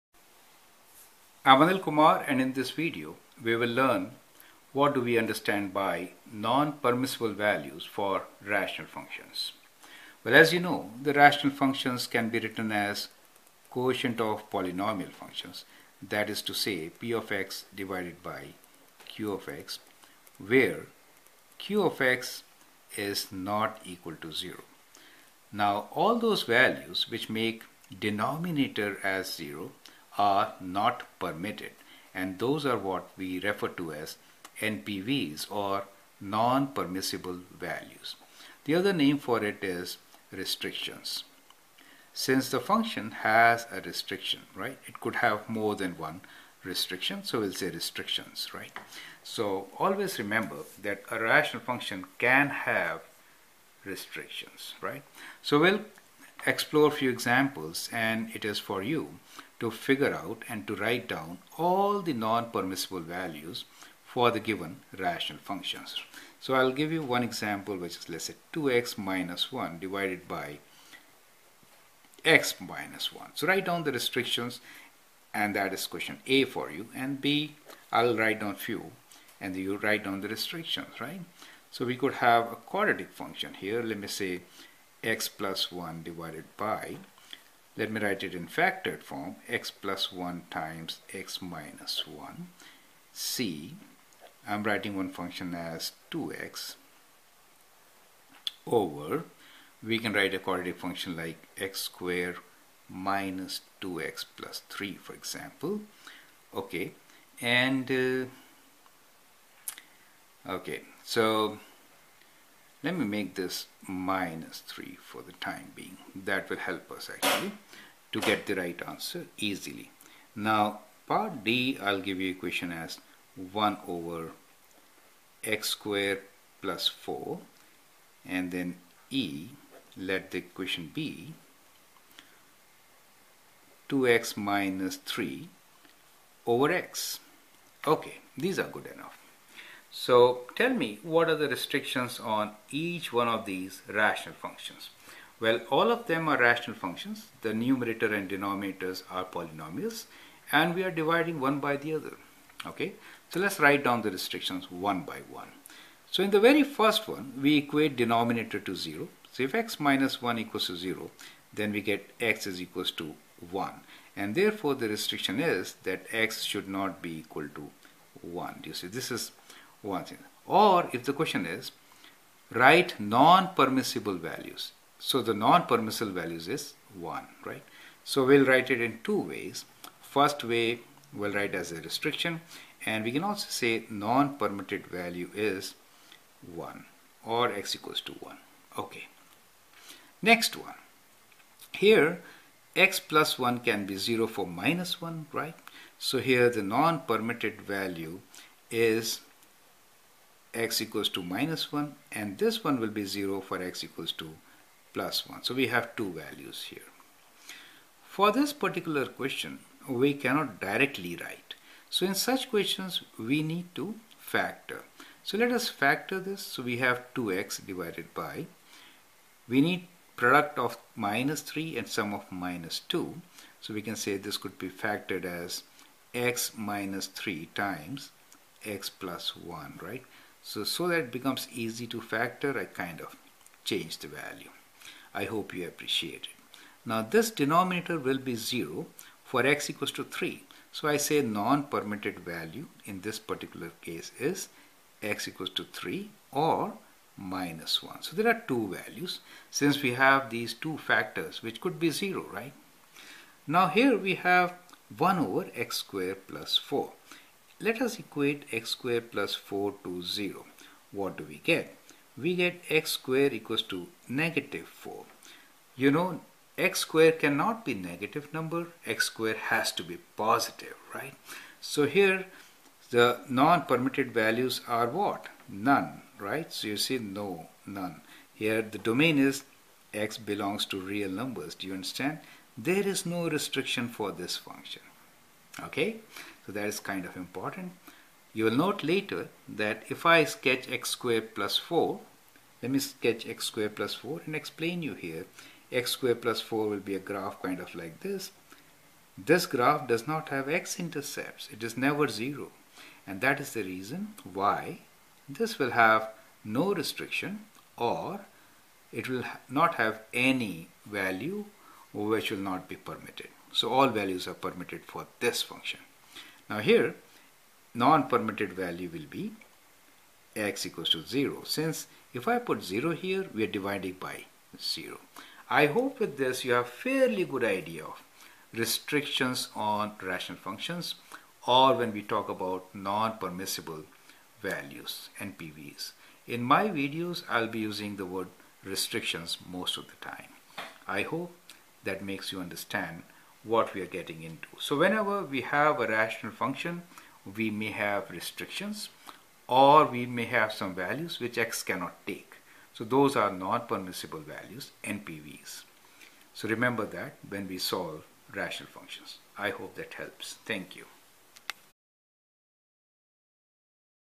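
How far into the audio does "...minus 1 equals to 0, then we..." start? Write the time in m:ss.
2:39.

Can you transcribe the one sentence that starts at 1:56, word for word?
That will help us actually to get the right answer easily.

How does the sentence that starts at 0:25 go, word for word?
Now all those values which make denominator as 0 are not permitted.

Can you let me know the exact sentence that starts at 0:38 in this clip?
The other name for it is restrictions.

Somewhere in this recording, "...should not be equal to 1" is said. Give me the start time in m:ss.
2:46.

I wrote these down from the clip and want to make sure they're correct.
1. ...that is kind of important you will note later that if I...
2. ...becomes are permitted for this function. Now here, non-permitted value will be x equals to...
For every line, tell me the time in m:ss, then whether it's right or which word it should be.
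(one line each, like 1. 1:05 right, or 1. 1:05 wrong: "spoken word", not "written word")
1. 4:46 right
2. 5:13 wrong: "values", not "becomes".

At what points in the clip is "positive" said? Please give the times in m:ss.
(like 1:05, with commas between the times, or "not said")
4:30.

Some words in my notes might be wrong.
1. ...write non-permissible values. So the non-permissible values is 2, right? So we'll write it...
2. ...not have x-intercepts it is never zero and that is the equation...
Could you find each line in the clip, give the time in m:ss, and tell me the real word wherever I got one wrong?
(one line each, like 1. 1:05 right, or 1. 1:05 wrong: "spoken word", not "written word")
1. 2:52 wrong: "1", not "2"
2. 5:00 wrong: "reason", not "equation".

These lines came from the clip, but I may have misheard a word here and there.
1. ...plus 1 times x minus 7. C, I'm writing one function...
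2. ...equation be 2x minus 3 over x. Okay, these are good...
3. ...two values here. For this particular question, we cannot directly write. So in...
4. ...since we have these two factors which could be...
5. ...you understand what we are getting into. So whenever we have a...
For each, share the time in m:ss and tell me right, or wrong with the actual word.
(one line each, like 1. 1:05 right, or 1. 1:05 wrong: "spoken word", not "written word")
1. 1:29 wrong: "1", not "7"
2. 2:10 right
3. 3:25 right
4. 4:09 right
5. 5:42 right.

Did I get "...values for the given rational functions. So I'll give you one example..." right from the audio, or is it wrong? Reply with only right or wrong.
right.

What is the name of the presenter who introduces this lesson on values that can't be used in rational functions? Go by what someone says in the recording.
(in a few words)
Anil Kumar.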